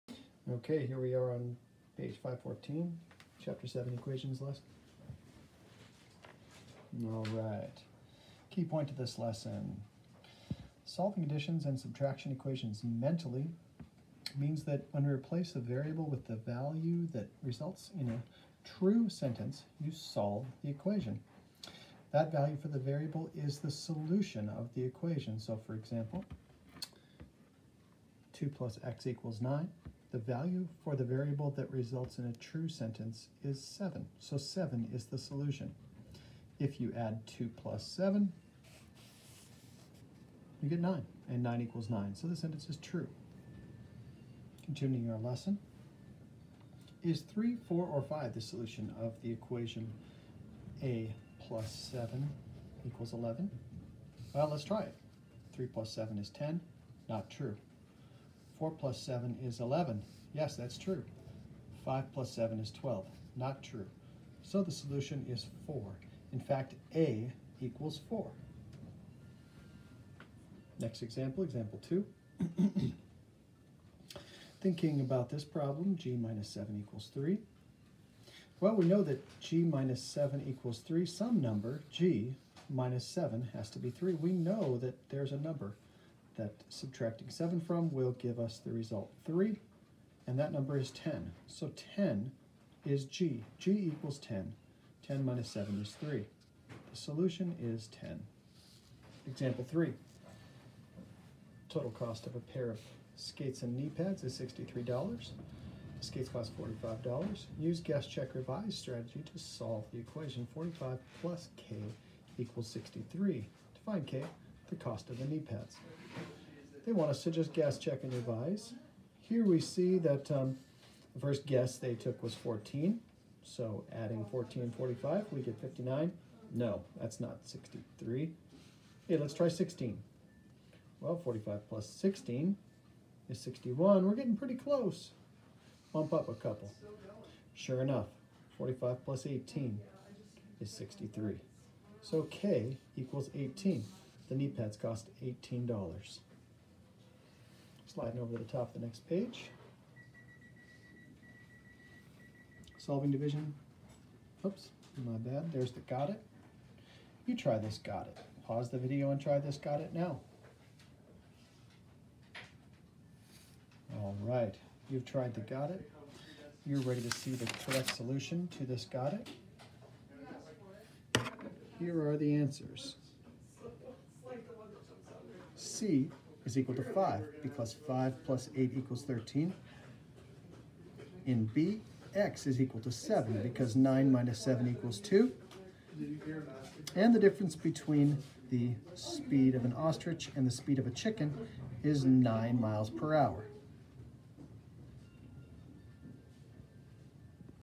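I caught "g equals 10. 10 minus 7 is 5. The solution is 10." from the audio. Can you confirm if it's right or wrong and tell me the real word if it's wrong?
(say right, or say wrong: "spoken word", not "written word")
wrong: "3", not "5".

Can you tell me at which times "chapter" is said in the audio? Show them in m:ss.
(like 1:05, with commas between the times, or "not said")
0:03.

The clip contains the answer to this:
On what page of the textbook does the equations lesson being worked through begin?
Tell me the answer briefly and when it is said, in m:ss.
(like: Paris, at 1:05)
514, at 0:02.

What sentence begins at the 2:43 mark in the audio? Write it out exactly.
All right, you've tried the got it.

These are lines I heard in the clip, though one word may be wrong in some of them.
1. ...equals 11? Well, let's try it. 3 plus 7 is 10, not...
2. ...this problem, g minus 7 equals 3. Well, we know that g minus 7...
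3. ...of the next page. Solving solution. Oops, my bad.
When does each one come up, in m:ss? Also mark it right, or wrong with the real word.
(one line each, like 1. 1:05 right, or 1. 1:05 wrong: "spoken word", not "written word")
1. 0:52 right
2. 1:15 right
3. 2:28 wrong: "division", not "solution".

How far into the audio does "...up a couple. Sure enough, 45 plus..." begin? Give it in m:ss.
2:16.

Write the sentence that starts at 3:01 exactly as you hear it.
In B, x is equal to 7 because 9 minus 7 equals 2.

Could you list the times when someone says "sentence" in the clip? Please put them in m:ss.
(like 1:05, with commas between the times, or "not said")
0:19, 0:32, 0:42.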